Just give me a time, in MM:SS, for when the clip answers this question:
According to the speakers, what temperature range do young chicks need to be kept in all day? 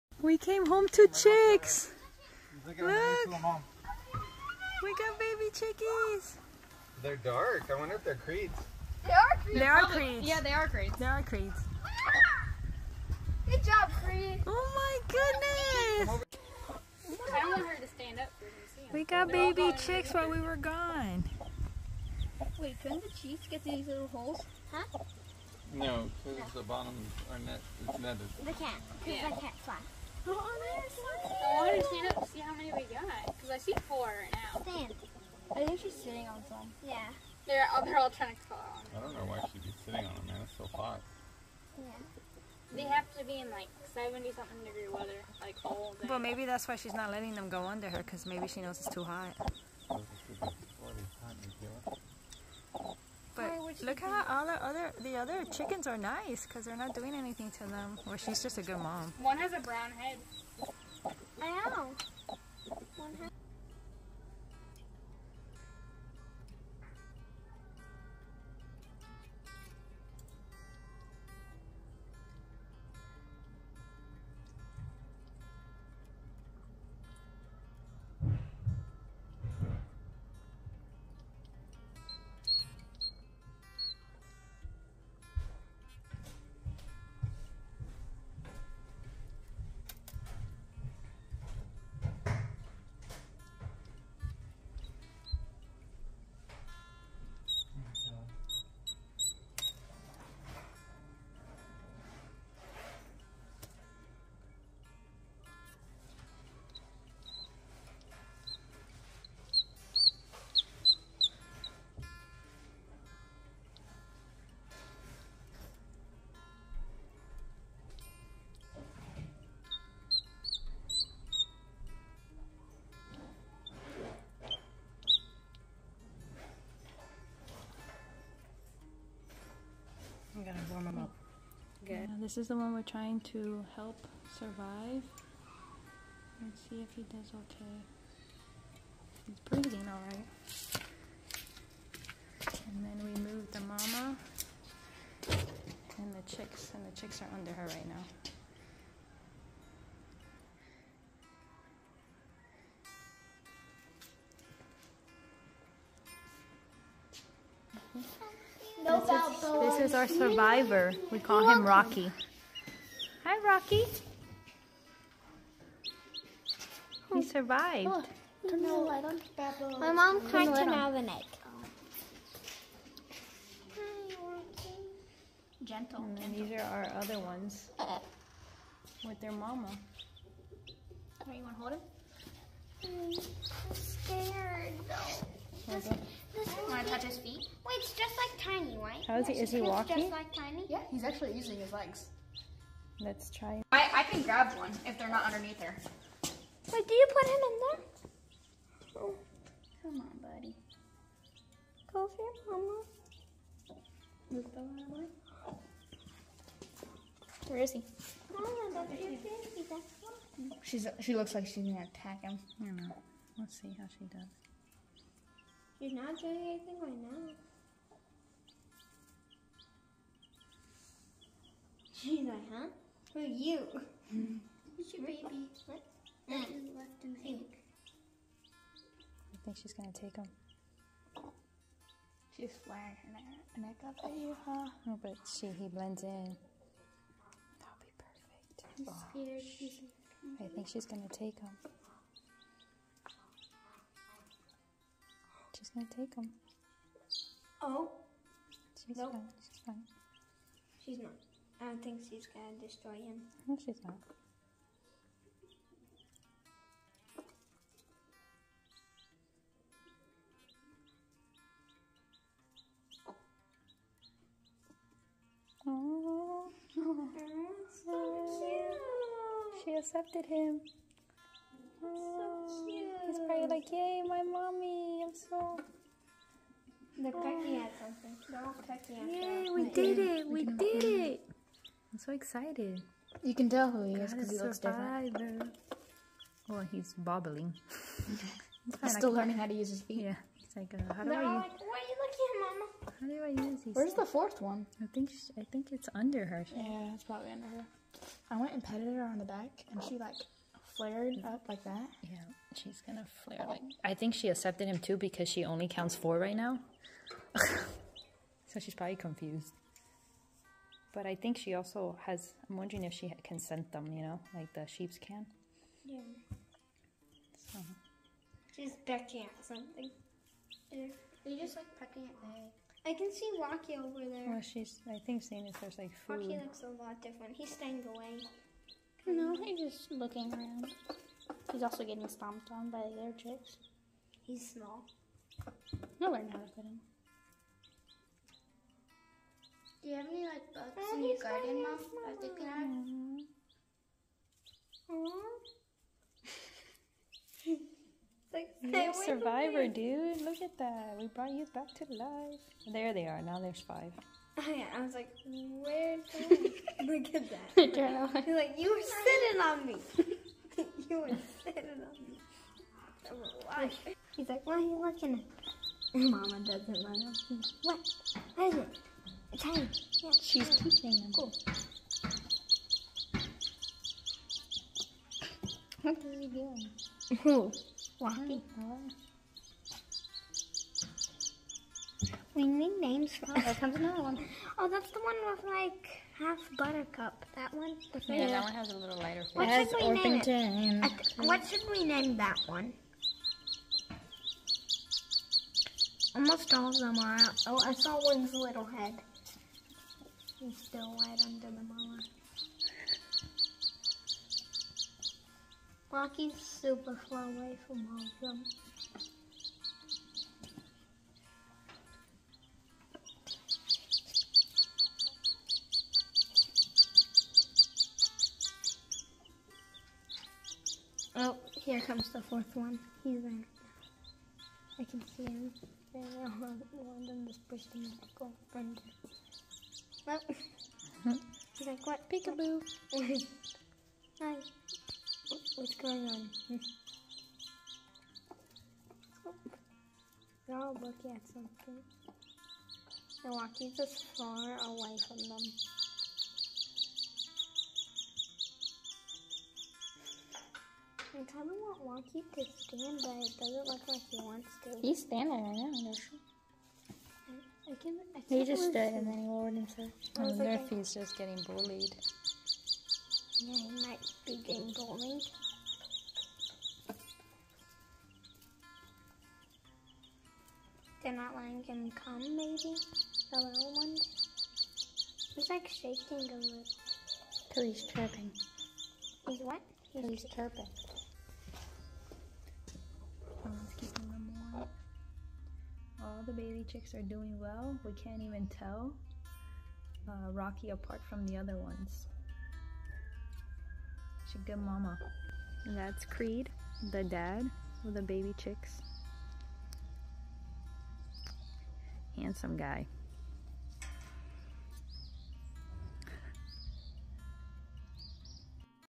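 00:43.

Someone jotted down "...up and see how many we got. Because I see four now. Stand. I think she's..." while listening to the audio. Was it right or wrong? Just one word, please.
right.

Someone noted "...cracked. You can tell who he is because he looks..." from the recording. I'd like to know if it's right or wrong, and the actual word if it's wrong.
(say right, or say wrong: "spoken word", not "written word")
wrong: "excited", not "cracked".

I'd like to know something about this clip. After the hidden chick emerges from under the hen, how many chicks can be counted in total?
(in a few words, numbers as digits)
5.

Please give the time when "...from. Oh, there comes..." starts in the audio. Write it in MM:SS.
06:23.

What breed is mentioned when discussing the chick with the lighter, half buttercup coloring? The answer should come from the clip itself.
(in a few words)
Orpington.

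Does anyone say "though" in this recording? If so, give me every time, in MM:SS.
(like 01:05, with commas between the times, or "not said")
03:04.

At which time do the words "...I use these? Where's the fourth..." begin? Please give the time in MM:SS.
04:53.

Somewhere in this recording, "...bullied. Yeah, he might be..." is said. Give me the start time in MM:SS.
07:41.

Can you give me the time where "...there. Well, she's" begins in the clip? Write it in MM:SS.
05:24.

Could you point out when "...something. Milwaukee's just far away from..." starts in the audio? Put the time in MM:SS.
07:21.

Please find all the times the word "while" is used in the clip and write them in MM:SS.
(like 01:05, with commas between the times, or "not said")
00:20.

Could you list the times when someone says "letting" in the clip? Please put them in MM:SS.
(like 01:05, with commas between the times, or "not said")
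00:47, 07:51.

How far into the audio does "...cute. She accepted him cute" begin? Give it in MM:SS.
04:28.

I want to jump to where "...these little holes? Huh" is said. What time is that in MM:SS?
00:23.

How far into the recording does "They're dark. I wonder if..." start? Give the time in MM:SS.
00:07.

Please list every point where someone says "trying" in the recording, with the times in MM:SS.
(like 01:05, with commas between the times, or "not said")
00:38, 02:12.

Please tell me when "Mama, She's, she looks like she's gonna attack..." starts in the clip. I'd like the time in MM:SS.
03:28.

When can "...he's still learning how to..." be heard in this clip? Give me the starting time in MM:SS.
04:48.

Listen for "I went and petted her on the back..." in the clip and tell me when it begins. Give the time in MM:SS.
04:58.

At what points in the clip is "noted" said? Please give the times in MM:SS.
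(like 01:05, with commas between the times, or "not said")
not said.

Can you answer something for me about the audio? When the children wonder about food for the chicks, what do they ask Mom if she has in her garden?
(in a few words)
Bugs.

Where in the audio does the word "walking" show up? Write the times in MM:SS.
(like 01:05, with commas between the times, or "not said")
03:09, 06:17.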